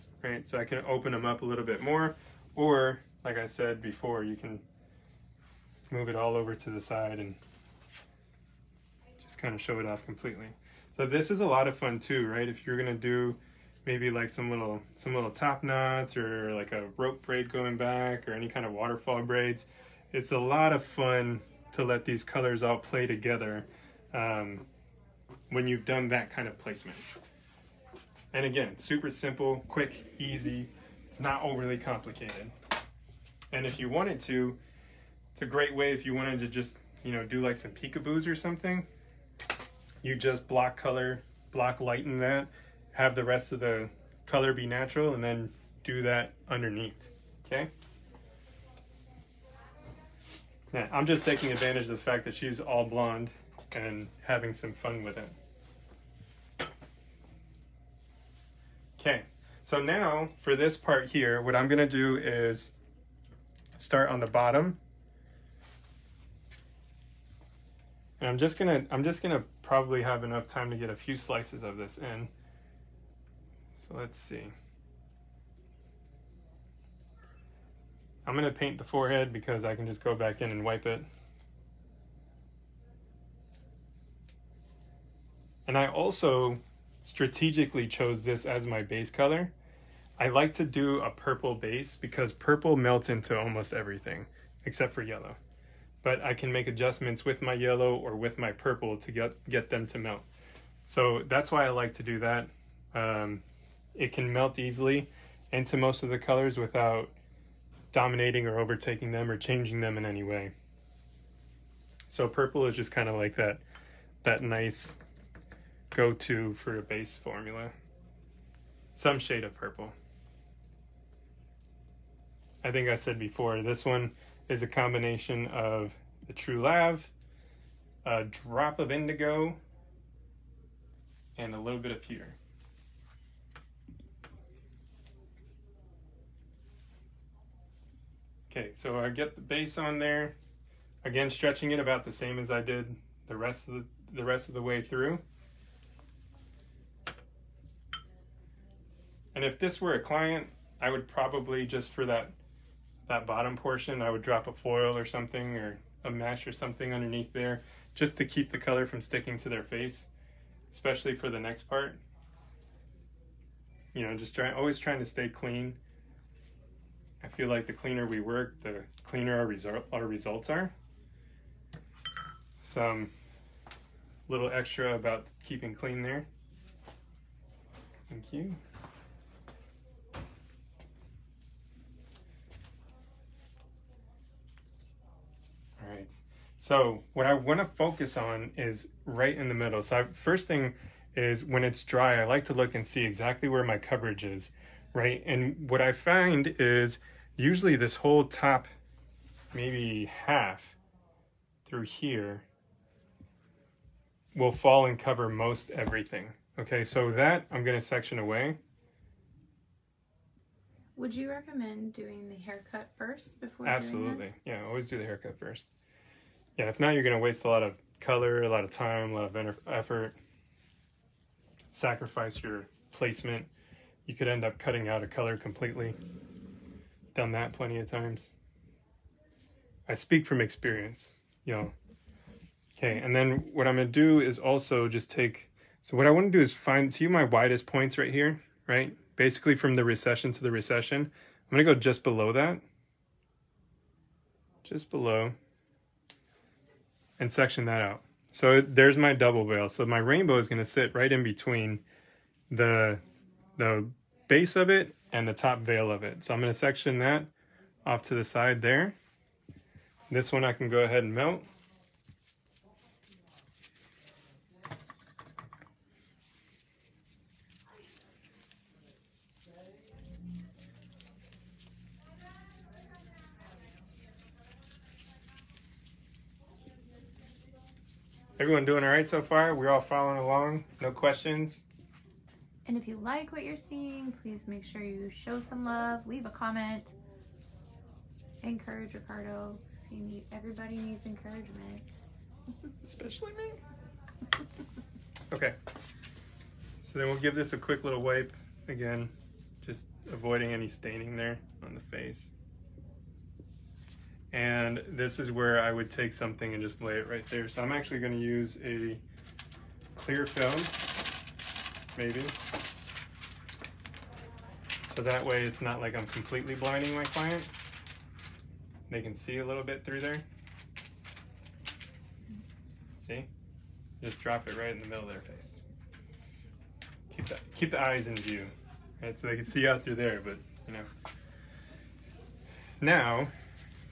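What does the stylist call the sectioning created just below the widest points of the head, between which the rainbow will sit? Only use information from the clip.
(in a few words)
double veil.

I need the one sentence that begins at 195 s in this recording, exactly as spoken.
And what I find is usually this whole top, maybe half through here, will fall and cover most everything.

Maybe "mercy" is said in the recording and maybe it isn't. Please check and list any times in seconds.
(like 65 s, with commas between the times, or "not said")
not said.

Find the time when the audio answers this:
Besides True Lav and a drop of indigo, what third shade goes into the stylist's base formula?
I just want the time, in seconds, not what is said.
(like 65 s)
131 s.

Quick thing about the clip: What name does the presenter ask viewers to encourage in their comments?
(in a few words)
Ricardo.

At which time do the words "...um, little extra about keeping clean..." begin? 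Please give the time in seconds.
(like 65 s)
173 s.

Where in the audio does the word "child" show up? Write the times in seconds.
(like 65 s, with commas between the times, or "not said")
not said.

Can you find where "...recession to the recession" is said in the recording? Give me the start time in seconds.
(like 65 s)
239 s.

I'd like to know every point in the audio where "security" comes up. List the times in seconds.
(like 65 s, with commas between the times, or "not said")
not said.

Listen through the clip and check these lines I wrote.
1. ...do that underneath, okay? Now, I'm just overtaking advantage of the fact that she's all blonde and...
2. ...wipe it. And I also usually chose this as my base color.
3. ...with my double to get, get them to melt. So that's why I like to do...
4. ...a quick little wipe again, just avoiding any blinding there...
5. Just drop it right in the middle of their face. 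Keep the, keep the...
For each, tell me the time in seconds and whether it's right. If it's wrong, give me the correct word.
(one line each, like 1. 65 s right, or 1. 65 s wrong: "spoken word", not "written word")
1. 45 s wrong: "taking", not "overtaking"
2. 80 s wrong: "strategically", not "usually"
3. 98 s wrong: "purple", not "double"
4. 297 s wrong: "staining", not "blinding"
5. 324 s right.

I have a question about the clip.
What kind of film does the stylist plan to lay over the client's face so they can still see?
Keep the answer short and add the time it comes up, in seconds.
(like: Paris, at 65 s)
clear film, at 308 s.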